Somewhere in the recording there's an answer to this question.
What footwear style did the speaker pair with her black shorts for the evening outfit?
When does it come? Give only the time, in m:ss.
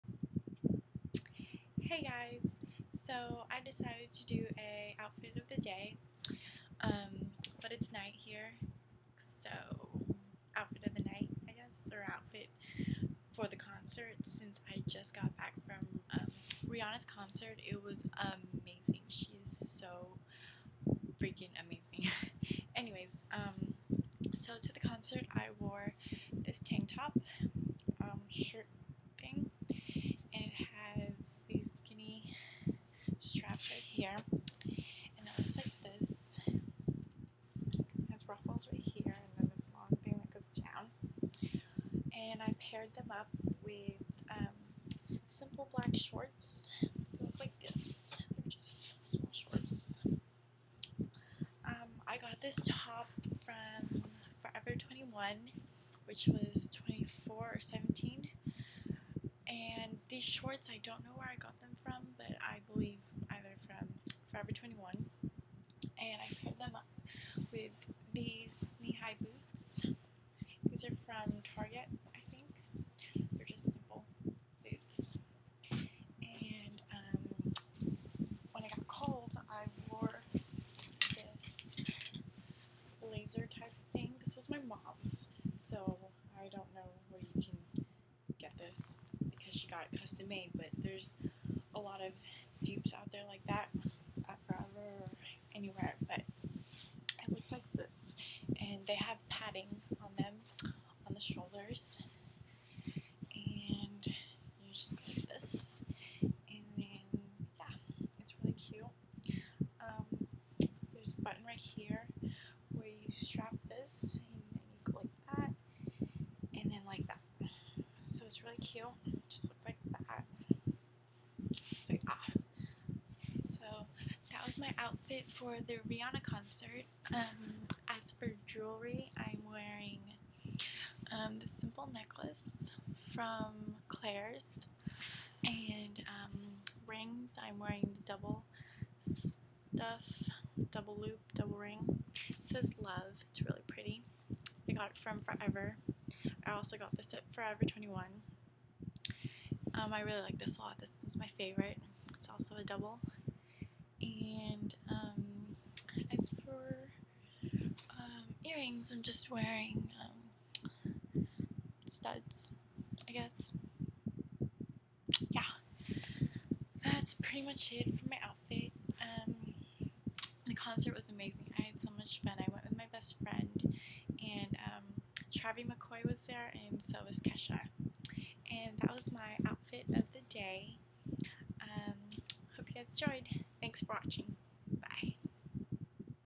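1:08.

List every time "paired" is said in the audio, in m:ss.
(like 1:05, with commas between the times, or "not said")
0:42, 1:06.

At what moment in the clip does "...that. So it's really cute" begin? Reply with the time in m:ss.
1:57.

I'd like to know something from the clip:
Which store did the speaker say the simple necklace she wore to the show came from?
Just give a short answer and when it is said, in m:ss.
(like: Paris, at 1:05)
Claire's, at 2:13.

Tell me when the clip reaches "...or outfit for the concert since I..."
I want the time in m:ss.
0:11.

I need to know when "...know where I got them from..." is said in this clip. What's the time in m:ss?
1:01.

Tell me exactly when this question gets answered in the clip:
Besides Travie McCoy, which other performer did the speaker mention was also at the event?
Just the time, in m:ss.
2:57.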